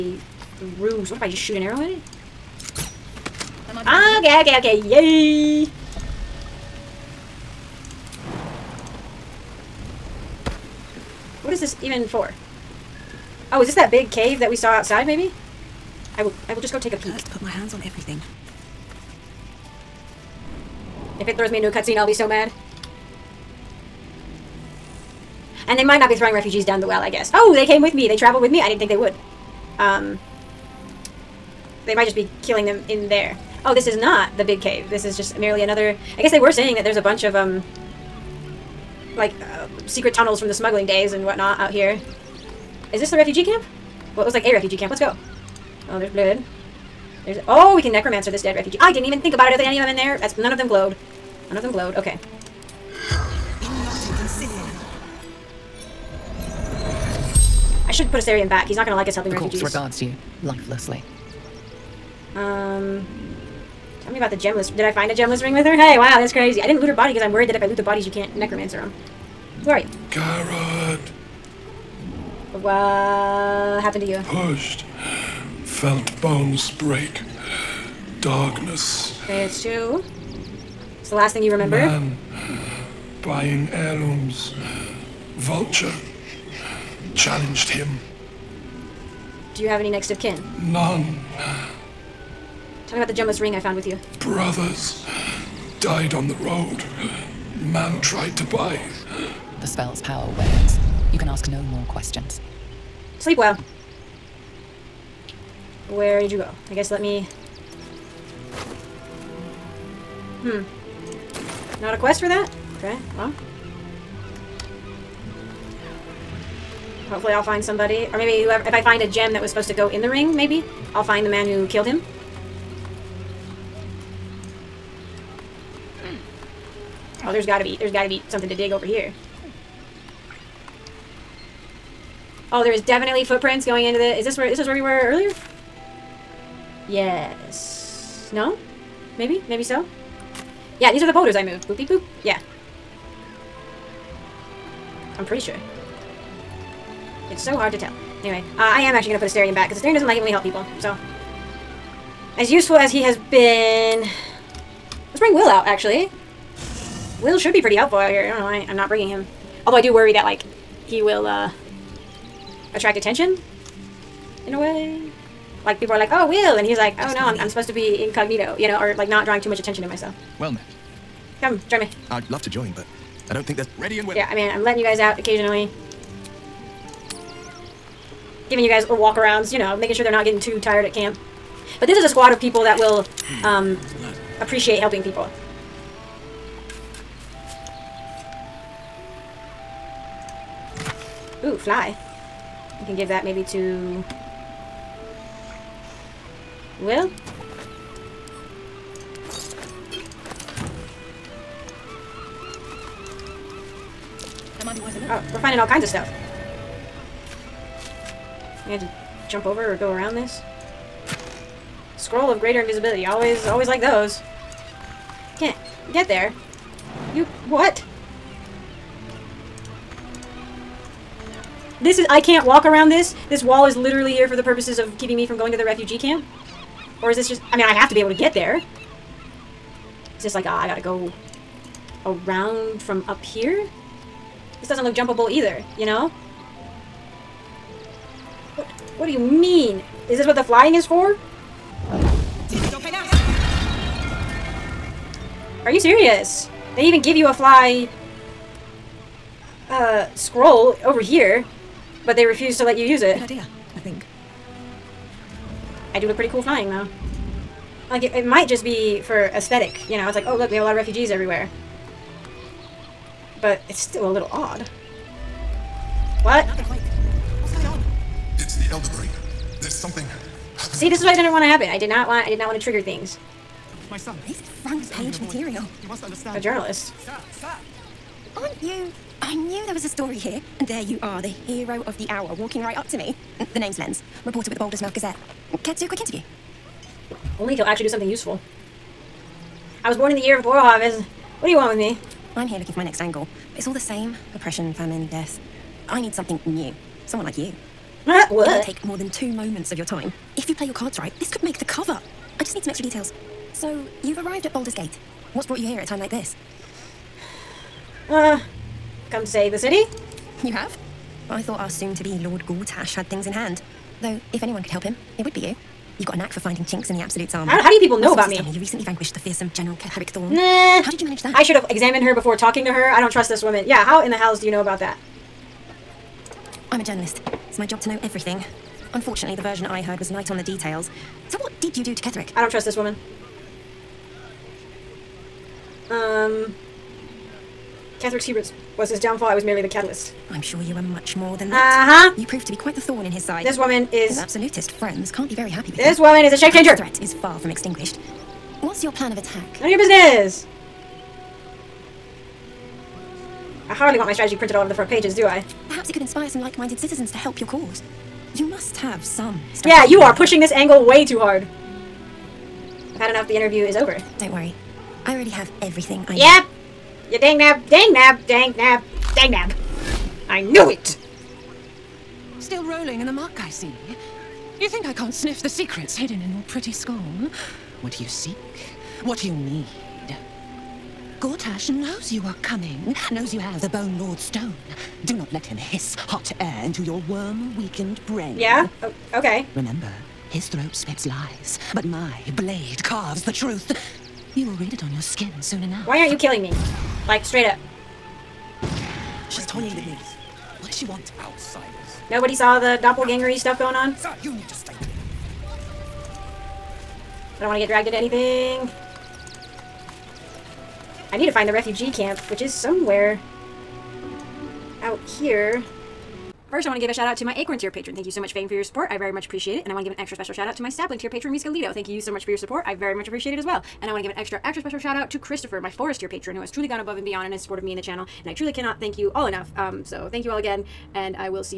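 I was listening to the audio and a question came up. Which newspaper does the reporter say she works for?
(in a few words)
Baldur's Mouth Gazette.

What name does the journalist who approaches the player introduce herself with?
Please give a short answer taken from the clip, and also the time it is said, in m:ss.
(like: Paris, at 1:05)
Lens, at 4:43.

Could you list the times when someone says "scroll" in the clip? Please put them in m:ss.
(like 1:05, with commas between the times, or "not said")
3:31, 4:10.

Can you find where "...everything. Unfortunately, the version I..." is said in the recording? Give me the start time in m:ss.
5:28.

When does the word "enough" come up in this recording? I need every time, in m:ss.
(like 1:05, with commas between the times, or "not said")
6:35, 7:09.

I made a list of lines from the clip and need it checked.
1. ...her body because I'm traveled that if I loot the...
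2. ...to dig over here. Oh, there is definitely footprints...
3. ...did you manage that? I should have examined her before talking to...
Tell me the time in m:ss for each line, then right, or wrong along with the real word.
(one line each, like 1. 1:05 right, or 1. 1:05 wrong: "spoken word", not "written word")
1. 1:06 wrong: "worried", not "traveled"
2. 2:08 right
3. 5:20 right.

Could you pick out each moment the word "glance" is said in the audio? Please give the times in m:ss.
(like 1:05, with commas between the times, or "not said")
not said.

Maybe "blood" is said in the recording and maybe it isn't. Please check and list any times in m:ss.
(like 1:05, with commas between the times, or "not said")
0:46.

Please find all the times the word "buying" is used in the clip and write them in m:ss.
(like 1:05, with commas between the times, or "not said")
1:23.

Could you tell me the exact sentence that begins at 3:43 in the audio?
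This wall is literally here for the purposes of keeping me from going to the refugee camp.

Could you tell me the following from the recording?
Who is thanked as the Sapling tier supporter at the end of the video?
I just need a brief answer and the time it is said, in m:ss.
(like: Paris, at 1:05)
Riska Lito, at 7:01.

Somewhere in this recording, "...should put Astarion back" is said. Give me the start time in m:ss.
0:57.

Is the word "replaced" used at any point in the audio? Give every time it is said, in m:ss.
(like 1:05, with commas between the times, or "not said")
not said.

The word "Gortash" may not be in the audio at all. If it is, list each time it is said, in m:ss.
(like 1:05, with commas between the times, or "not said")
5:12, 6:21.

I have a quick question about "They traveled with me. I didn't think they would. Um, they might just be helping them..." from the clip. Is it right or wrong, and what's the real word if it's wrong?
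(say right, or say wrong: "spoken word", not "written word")
wrong: "killing", not "helping".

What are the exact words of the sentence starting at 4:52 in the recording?
I'm here looking for my next angle.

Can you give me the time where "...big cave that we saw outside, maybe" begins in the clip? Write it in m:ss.
0:13.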